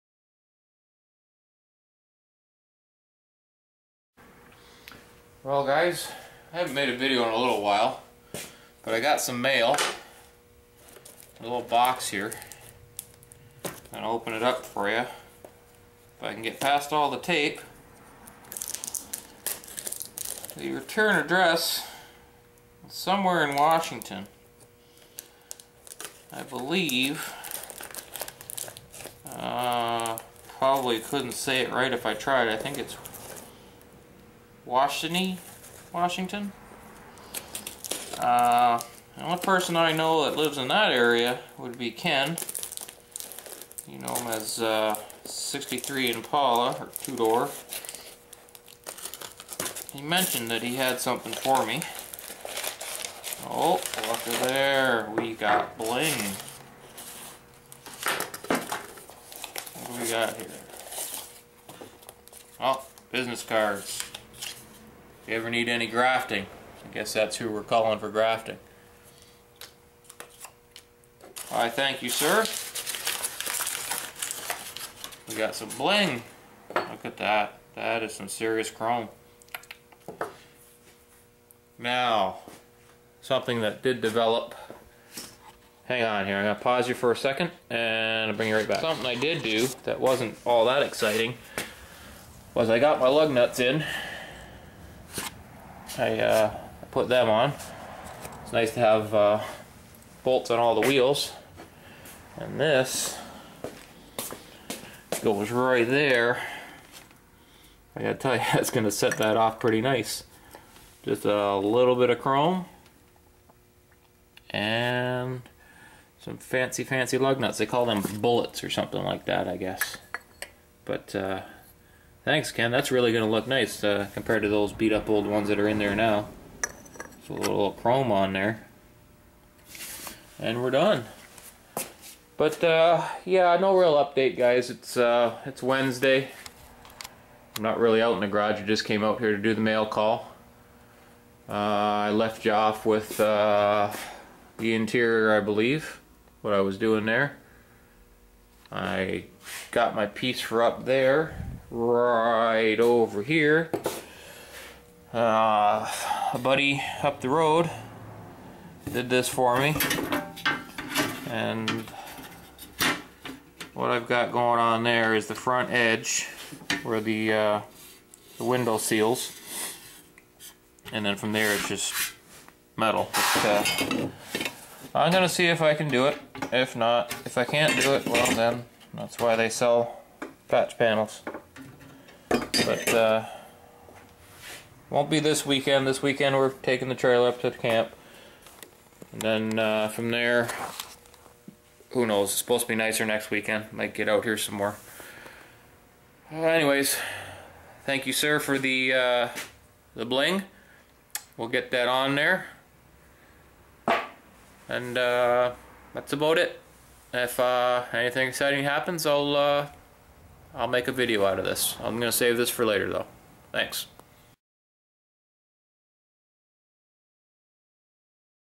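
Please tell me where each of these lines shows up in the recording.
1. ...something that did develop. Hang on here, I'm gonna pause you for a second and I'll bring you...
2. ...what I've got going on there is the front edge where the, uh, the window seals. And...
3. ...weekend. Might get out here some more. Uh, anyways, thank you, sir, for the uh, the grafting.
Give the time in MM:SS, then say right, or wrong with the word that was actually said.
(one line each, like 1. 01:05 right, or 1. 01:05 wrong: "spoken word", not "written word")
1. 01:23 right
2. 02:43 right
3. 03:13 wrong: "bling", not "grafting".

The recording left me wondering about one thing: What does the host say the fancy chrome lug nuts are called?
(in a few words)
Bullets.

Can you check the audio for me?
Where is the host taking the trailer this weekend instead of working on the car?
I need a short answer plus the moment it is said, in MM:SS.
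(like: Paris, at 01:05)
The camp, at 03:07.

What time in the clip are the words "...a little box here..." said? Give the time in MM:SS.
00:11.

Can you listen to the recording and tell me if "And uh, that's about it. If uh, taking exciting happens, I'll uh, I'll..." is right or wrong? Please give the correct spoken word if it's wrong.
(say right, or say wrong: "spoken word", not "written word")
wrong: "anything", not "taking".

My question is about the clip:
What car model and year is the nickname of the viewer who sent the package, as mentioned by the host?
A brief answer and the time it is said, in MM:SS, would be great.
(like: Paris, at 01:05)
63 Impala, at 00:45.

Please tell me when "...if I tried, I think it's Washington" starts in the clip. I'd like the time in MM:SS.
00:31.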